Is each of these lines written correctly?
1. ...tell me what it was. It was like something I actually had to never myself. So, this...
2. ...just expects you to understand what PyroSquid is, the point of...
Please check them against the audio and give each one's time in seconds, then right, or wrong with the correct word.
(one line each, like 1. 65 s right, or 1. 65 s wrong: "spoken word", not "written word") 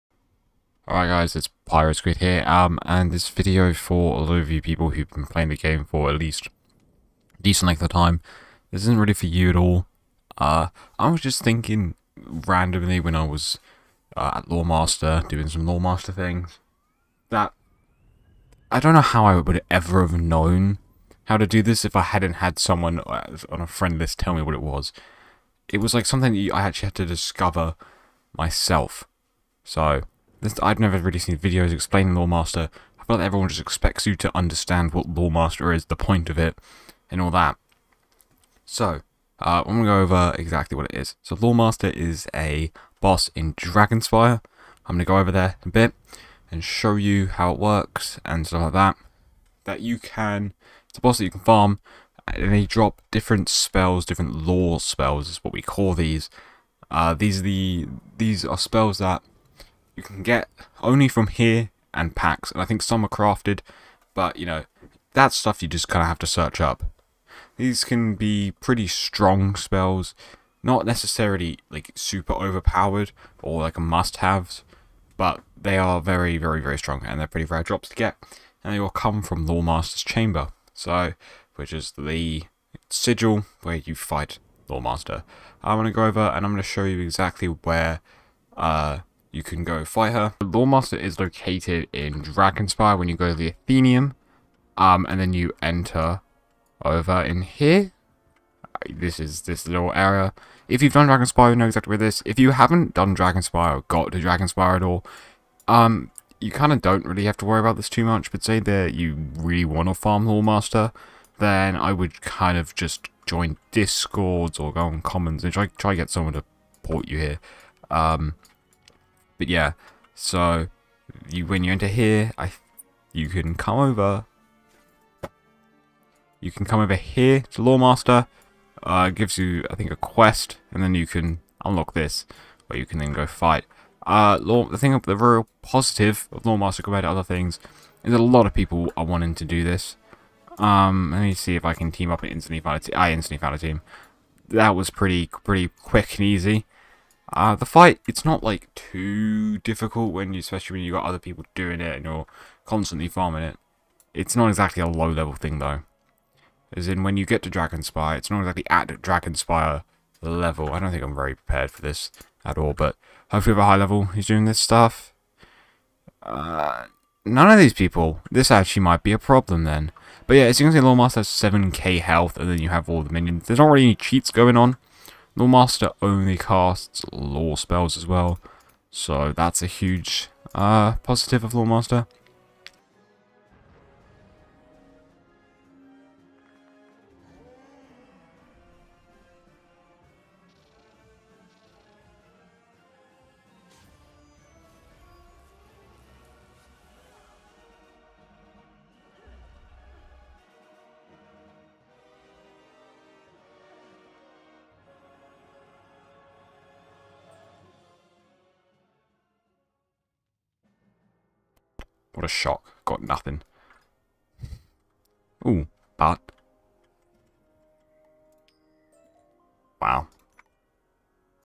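1. 24 s wrong: "discover", not "never"
2. 33 s wrong: "Loremaster", not "PyroSquid".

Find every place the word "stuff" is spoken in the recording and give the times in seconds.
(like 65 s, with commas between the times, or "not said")
48 s, 65 s, 164 s.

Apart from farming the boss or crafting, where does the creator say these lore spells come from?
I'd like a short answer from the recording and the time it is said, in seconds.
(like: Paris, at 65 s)
Packs, at 62 s.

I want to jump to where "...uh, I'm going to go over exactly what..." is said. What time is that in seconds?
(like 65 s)
39 s.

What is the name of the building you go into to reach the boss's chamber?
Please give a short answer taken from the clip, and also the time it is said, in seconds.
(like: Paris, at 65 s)
Athenaeum, at 93 s.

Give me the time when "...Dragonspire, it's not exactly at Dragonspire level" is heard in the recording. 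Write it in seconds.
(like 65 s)
157 s.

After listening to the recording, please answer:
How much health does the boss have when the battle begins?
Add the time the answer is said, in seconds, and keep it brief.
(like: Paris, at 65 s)
7k, at 171 s.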